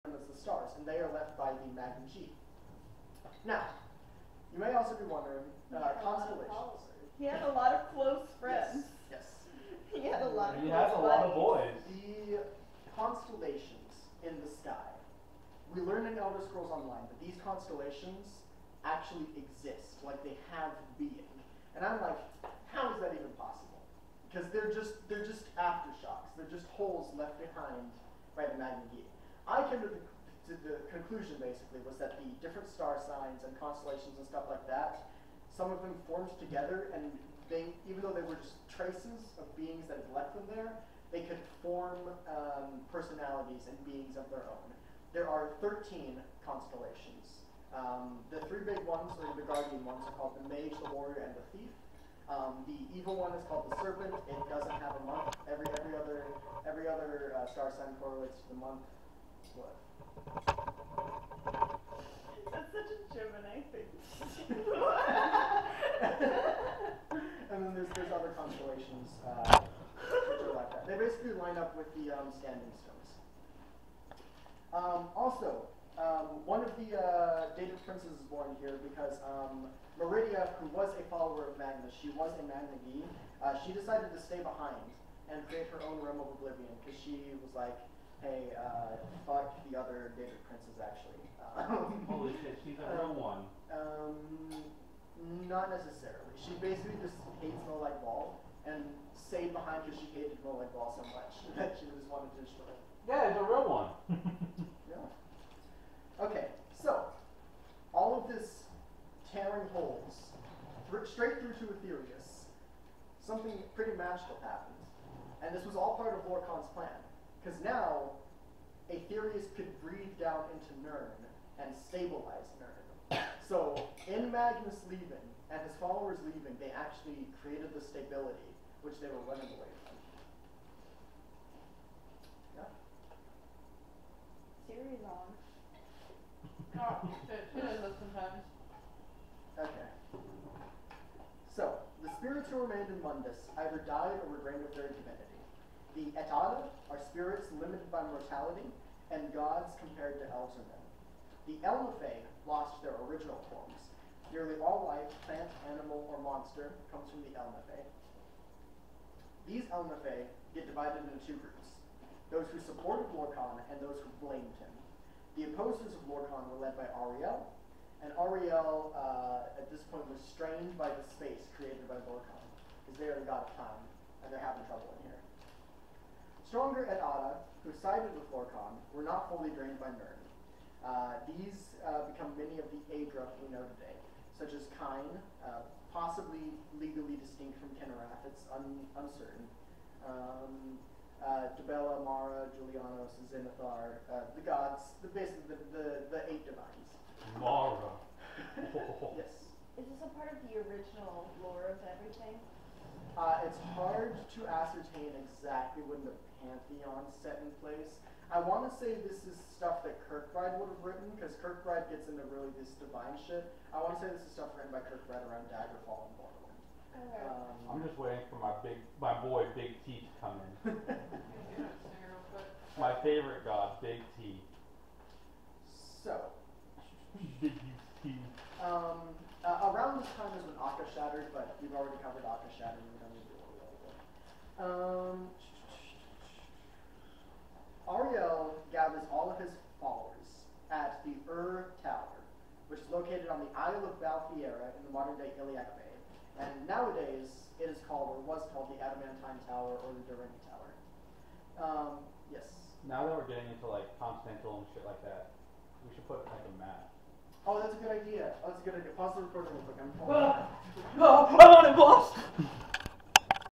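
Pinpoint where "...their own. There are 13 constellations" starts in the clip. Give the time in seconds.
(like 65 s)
44 s.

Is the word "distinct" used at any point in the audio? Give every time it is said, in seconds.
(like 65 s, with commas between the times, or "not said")
187 s.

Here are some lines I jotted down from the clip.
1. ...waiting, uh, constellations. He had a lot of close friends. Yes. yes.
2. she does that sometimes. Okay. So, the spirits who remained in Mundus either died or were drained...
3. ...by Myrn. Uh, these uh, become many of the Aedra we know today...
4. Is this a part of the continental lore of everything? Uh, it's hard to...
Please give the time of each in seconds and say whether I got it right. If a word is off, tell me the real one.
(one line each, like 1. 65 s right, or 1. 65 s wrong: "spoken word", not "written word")
1. 5 s wrong: "wondering", not "waiting"
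2. 136 s right
3. 179 s right
4. 199 s wrong: "original", not "continental".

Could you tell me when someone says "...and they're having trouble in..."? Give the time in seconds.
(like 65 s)
174 s.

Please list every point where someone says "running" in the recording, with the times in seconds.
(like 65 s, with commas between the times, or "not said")
129 s.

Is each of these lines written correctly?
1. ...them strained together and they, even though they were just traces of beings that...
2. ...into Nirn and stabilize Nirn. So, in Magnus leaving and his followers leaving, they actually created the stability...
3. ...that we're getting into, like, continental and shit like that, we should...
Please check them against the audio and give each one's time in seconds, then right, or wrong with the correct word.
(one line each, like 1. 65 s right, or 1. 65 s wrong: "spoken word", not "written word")
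1. 35 s wrong: "formed", not "strained"
2. 120 s right
3. 253 s right.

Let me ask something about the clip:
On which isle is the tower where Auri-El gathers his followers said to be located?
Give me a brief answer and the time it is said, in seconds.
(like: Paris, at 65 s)
Balfiera, at 243 s.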